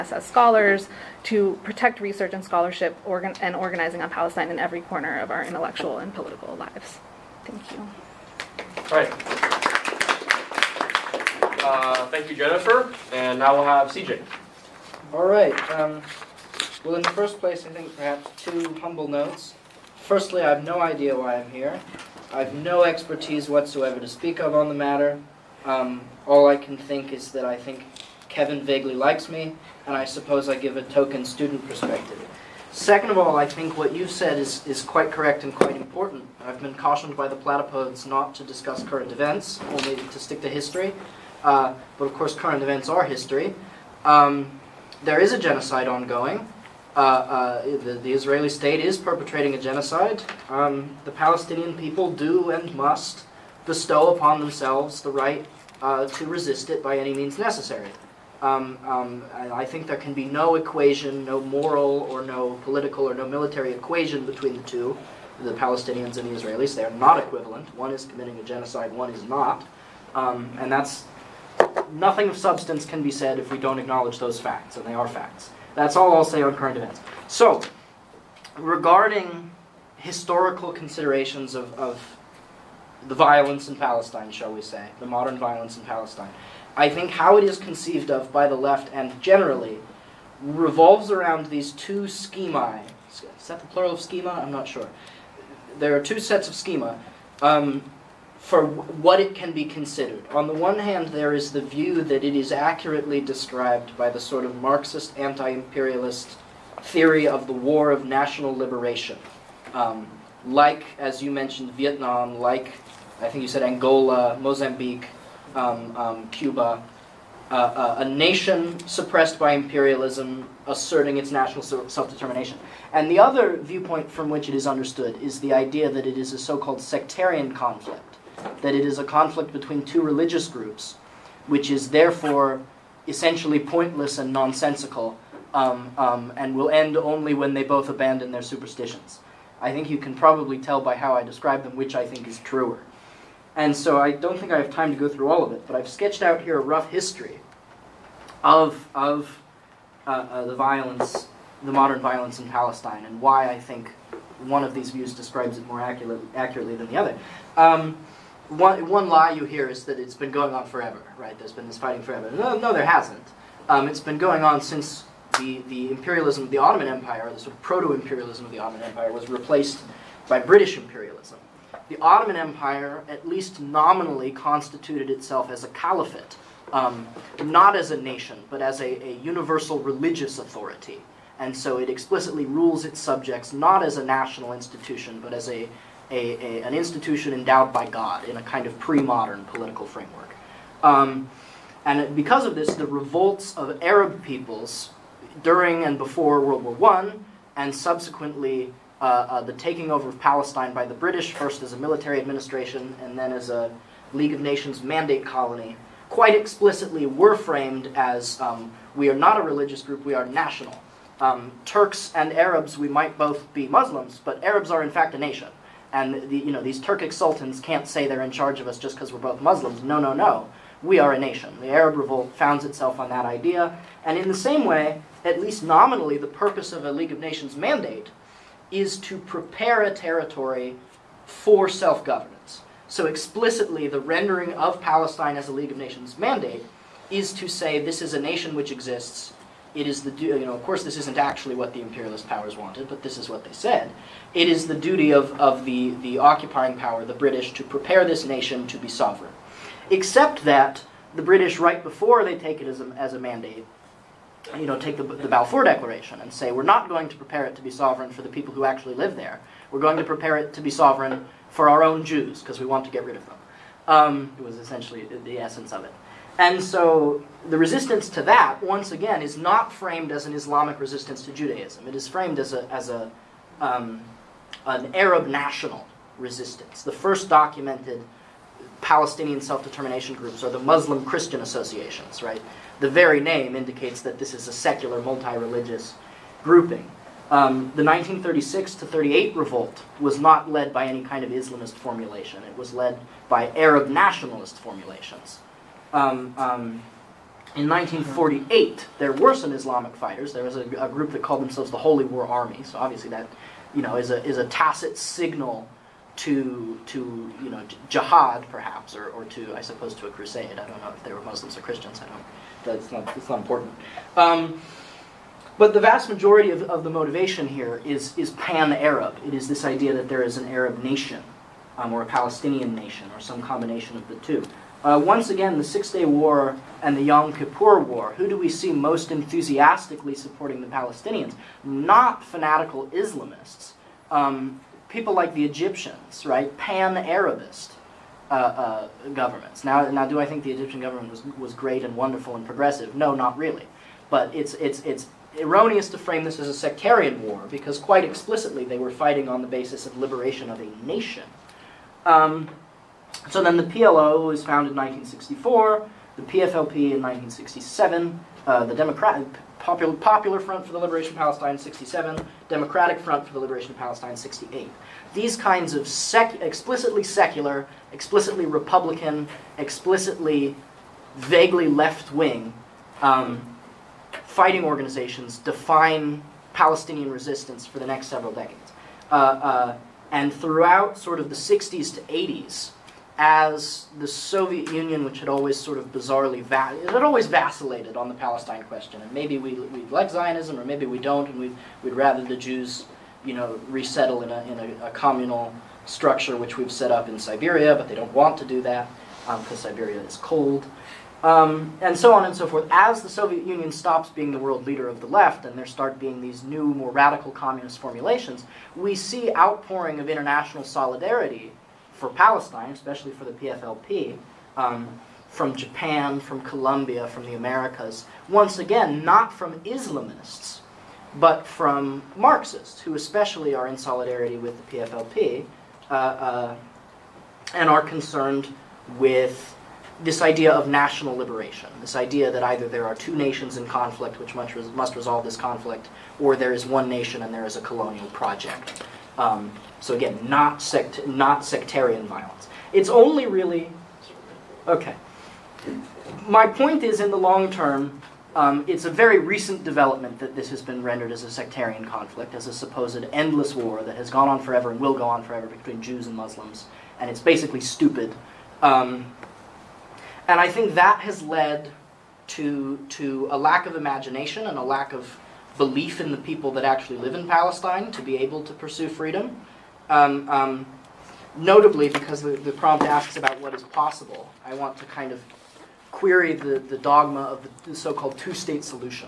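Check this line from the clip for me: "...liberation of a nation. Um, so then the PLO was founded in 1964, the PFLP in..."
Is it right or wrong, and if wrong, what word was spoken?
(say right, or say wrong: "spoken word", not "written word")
right.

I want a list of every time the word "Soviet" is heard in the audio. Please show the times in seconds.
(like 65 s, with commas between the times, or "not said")
384 s, 403 s.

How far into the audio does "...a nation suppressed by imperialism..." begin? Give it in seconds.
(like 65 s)
117 s.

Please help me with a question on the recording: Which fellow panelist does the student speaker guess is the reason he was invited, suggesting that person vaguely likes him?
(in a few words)
Kevin.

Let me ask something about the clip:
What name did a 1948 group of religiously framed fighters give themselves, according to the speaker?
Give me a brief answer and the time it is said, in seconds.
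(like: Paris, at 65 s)
Holy War Army, at 301 s.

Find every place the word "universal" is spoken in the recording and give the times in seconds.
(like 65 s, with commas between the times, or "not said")
179 s.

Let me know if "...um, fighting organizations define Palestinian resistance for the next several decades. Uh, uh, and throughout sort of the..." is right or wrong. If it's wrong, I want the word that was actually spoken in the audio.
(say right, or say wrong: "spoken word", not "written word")
right.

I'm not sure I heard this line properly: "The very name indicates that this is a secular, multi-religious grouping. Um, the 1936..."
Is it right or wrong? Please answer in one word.
right.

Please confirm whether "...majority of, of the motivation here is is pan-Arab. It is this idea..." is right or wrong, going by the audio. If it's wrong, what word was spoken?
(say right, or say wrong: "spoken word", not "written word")
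right.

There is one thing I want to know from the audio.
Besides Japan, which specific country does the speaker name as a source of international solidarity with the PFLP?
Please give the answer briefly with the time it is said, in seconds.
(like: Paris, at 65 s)
Colombia, at 416 s.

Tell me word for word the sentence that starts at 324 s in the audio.
Uh, once again, the Six Day War and the Yom Kippur War.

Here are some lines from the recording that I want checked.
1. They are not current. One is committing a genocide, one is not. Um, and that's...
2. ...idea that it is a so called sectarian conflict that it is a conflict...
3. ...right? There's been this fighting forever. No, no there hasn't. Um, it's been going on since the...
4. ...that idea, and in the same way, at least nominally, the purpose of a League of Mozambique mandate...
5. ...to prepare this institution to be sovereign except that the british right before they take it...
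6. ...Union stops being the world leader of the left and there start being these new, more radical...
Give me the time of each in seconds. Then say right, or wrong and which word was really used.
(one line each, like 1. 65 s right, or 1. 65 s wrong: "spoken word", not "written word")
1. 66 s wrong: "equivalent", not "current"
2. 125 s right
3. 161 s right
4. 223 s wrong: "Nations", not "Mozambique"
5. 247 s wrong: "nation", not "institution"
6. 403 s right.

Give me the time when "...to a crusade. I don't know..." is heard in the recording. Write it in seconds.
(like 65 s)
309 s.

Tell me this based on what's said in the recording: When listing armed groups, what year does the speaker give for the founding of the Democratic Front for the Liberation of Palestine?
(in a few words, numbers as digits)
1968.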